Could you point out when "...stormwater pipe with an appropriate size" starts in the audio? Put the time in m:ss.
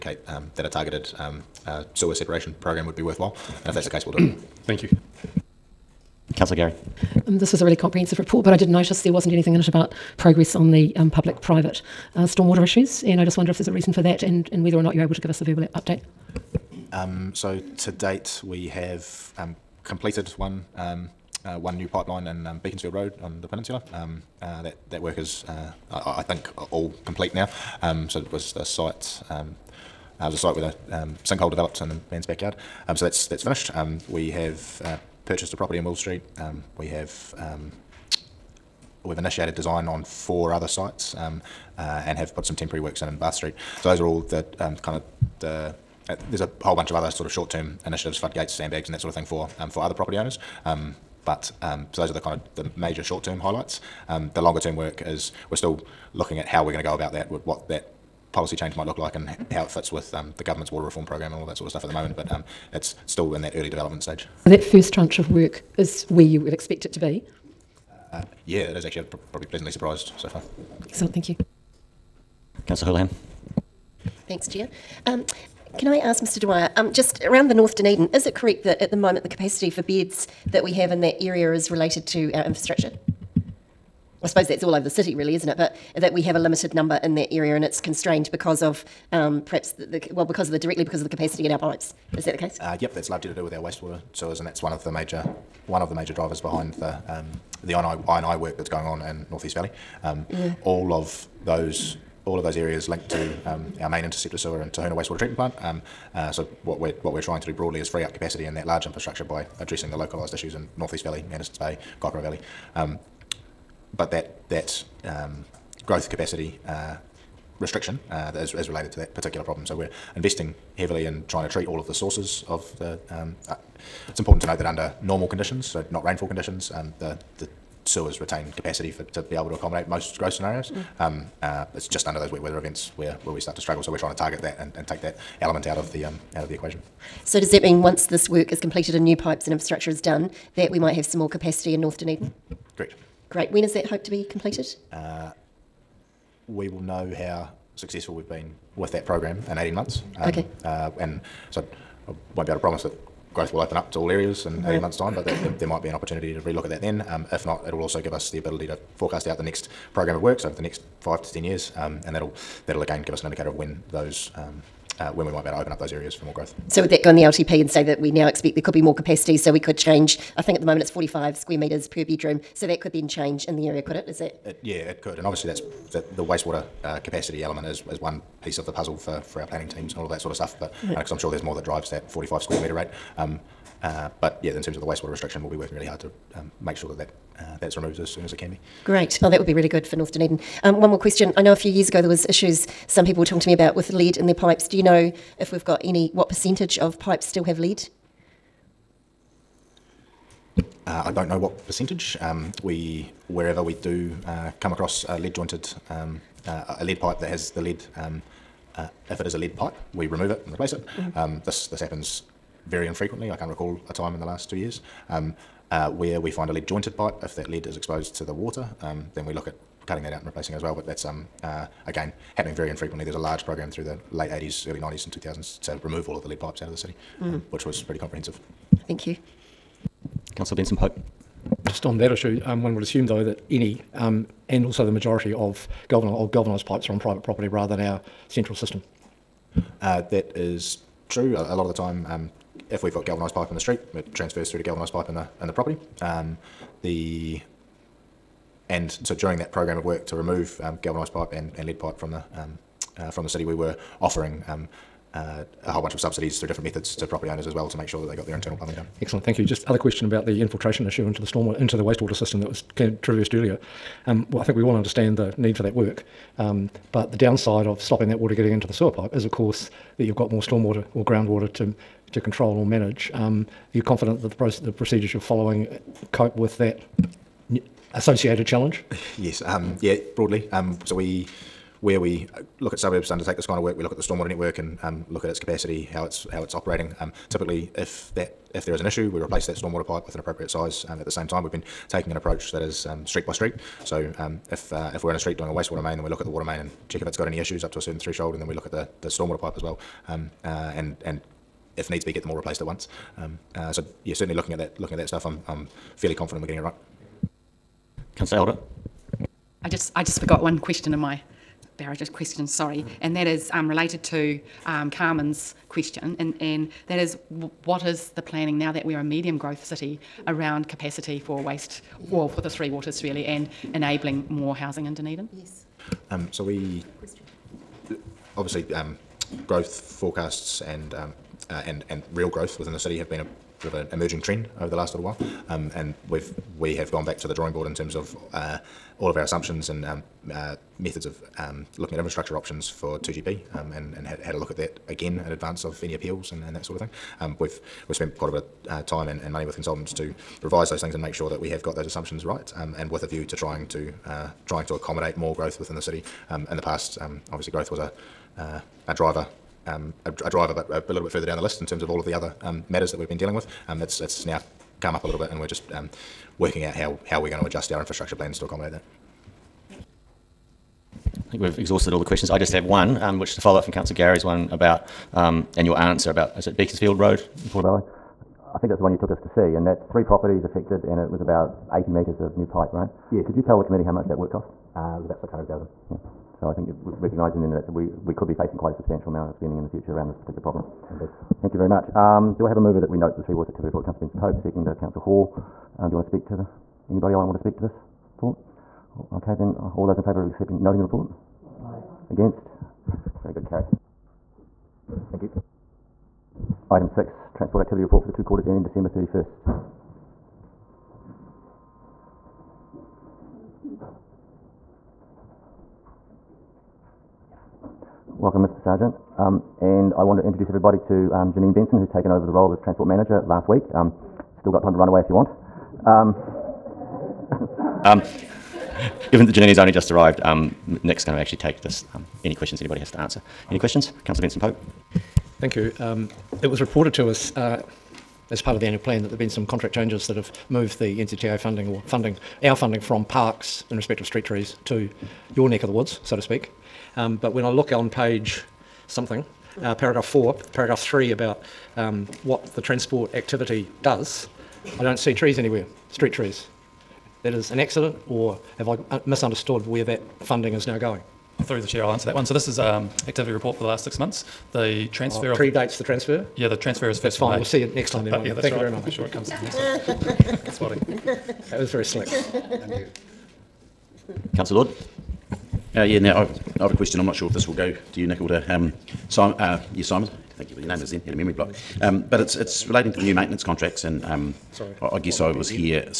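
4:49.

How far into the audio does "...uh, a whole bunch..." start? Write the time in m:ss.
4:15.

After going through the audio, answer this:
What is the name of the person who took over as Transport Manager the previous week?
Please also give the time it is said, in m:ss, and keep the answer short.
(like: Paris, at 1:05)
Janine Benson, at 7:01.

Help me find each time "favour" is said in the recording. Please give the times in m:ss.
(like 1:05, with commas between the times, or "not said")
6:40.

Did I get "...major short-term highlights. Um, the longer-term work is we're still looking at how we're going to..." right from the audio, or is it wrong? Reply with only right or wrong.
right.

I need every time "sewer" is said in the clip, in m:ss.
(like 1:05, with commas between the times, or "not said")
0:01, 1:34, 1:44, 2:07, 4:28.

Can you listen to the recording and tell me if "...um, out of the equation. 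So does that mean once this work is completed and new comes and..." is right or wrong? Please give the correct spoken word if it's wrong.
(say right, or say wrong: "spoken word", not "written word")
wrong: "pipes", not "comes".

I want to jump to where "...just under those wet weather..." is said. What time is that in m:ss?
2:11.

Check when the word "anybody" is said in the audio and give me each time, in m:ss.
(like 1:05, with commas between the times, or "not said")
6:36, 7:12.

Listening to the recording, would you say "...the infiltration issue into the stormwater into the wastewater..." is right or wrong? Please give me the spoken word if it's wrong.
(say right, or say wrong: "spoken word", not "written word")
right.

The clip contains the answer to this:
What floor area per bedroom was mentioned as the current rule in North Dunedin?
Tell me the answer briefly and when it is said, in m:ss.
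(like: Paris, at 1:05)
45 square metres, at 2:50.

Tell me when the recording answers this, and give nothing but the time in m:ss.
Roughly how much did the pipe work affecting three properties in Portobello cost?
6:25.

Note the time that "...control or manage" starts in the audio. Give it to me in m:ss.
4:32.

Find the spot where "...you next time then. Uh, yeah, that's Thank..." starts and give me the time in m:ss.
7:47.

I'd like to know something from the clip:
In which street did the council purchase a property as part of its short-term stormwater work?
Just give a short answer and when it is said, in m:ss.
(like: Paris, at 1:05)
Will Street, at 0:35.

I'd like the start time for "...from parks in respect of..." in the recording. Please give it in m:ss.
7:22.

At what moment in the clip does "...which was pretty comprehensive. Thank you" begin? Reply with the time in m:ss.
3:47.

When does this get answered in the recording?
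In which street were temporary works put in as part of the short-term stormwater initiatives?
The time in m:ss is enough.
0:43.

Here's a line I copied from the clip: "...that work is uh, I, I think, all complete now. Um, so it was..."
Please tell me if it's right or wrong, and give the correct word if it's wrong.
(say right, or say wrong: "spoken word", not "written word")
right.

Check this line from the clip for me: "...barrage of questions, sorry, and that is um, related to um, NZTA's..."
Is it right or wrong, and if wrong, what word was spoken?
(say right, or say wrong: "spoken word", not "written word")
wrong: "Carmen", not "NZTA".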